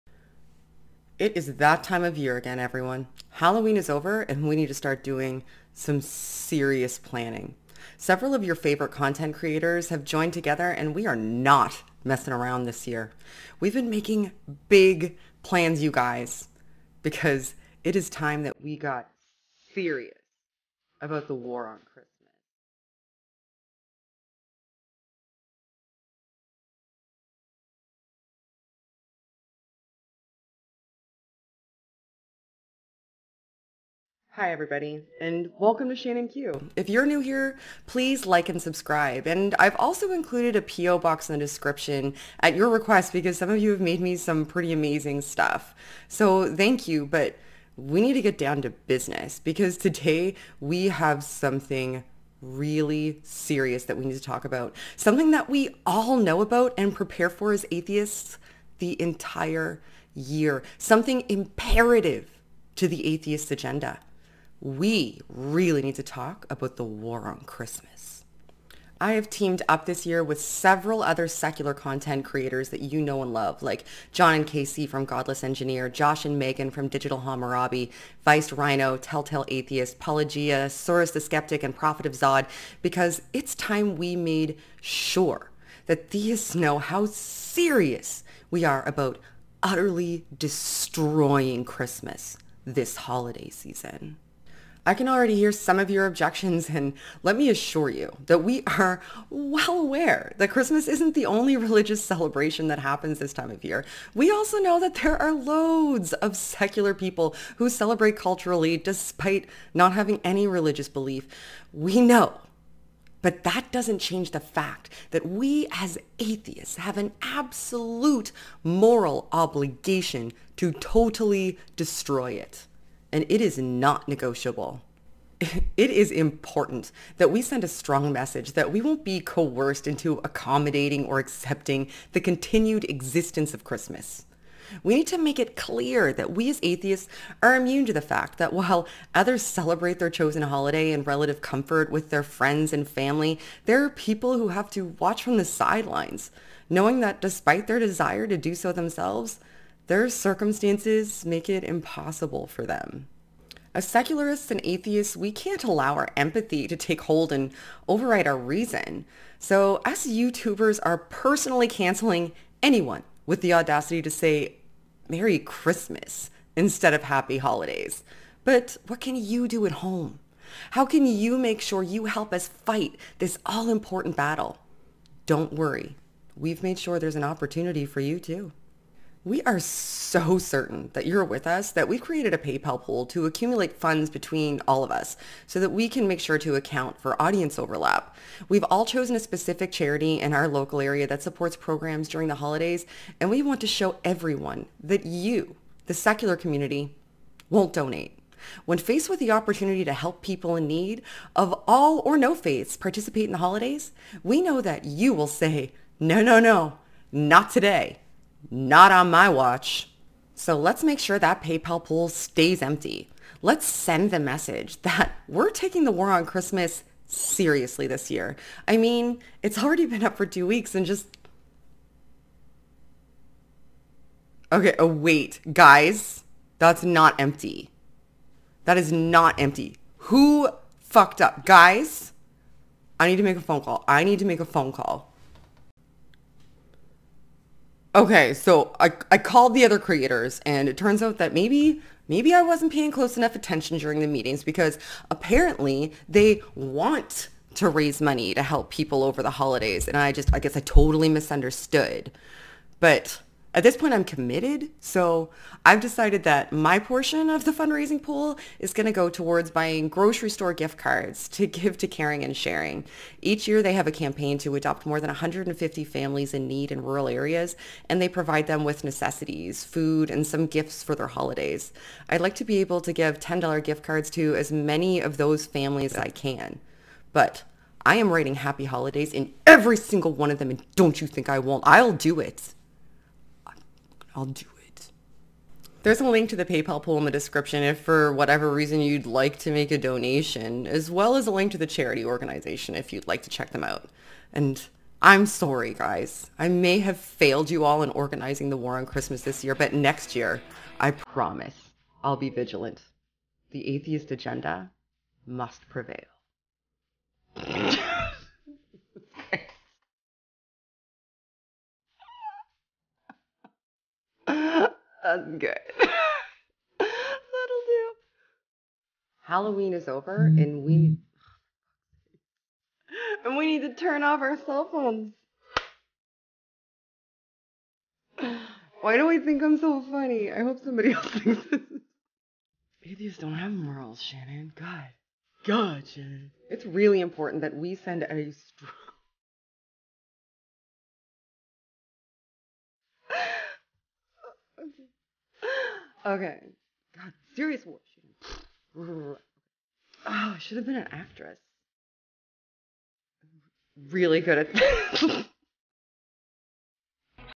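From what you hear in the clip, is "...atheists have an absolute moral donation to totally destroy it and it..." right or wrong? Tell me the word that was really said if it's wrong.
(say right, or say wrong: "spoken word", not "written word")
wrong: "obligation", not "donation".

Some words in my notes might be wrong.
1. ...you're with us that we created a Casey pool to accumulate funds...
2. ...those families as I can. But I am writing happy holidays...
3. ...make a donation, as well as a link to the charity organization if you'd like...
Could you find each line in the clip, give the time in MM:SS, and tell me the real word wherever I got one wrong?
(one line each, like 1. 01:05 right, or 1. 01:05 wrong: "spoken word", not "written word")
1. 03:01 wrong: "PayPal", not "Casey"
2. 04:35 right
3. 04:49 right.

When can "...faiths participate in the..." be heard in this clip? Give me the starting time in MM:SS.
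03:22.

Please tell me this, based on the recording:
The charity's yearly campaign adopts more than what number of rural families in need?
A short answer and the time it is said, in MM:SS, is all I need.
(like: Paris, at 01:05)
150, at 04:25.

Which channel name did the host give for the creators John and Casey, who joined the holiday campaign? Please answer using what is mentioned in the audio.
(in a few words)
Godless Engineer.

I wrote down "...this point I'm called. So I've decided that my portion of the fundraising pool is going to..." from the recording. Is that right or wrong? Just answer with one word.
wrong.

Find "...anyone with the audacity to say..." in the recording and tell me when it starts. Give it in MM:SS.
02:42.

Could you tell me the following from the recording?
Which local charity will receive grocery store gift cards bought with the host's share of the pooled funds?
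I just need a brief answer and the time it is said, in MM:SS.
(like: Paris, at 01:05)
Caring and Sharing, at 04:21.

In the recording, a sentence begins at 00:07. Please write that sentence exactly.
Several of your favorite content creators have joined together and we are not messing around this year.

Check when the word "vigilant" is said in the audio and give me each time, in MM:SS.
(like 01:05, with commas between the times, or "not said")
05:02.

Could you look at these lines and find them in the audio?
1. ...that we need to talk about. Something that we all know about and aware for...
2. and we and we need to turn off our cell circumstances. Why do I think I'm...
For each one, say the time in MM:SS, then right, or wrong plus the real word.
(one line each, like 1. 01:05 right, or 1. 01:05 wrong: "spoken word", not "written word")
1. 00:53 wrong: "prepare", not "aware"
2. 05:20 wrong: "phones", not "circumstances".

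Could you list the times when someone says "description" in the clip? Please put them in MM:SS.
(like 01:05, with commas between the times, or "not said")
00:41, 04:47.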